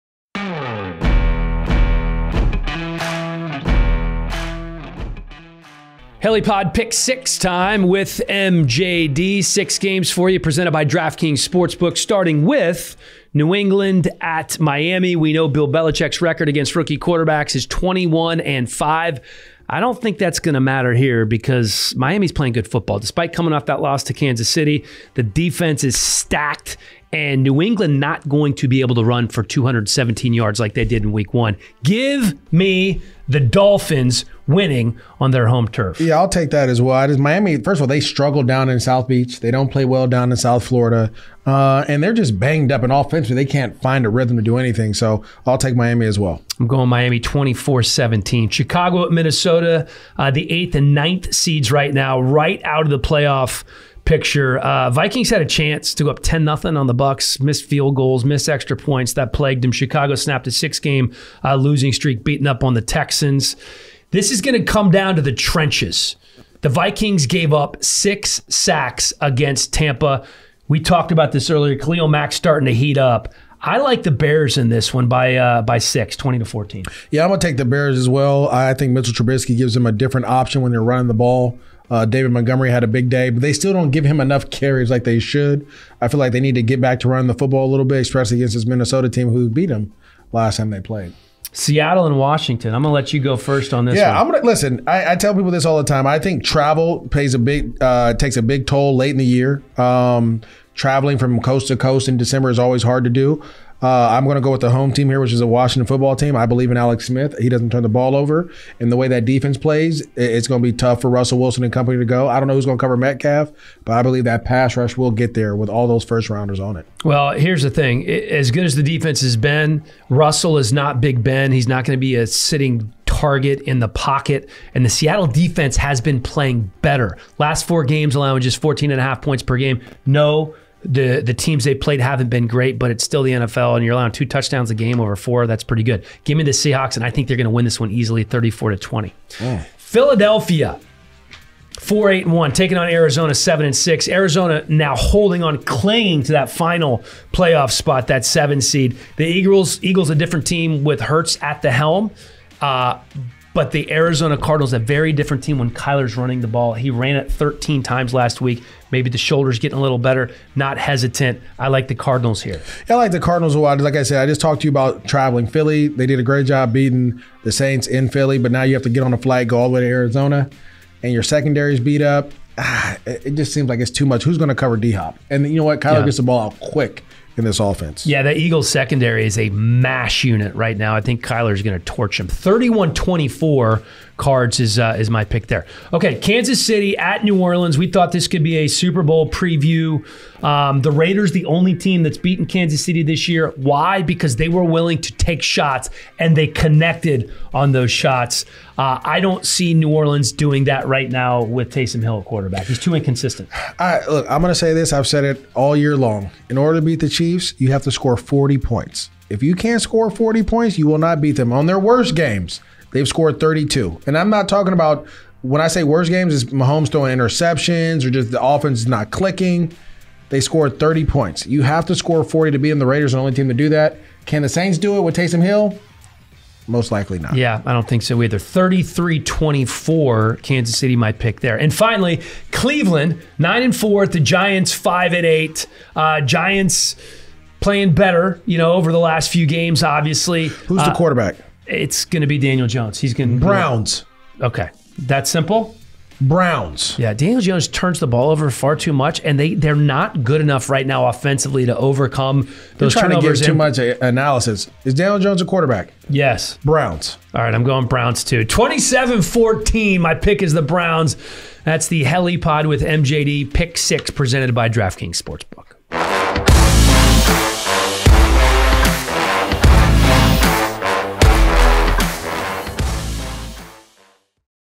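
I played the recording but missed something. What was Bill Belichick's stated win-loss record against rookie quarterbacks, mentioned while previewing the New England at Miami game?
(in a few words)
21 and 5.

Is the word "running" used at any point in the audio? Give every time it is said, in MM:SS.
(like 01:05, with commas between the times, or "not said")
01:20, 01:27, 02:36.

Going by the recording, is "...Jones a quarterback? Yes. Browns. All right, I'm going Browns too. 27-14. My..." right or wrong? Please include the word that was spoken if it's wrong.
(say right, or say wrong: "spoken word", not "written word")
right.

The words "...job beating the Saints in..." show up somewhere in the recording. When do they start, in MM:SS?
02:46.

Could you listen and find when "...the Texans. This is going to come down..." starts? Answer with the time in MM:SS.
01:02.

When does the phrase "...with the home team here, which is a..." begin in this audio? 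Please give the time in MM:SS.
01:44.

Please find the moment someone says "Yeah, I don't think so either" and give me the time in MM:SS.
03:47.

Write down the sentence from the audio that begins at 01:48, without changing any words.
And the way that defense plays, it's going to be tough for Russell Wilson and company to go.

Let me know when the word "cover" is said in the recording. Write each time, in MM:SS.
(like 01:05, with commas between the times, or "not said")
01:52, 02:54.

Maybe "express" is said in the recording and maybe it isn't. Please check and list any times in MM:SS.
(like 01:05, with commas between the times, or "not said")
not said.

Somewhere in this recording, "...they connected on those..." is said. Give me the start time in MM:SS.
03:16.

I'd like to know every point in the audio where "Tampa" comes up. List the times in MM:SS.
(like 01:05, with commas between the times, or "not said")
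01:09.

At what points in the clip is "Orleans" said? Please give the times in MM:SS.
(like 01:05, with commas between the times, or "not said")
03:07, 03:19.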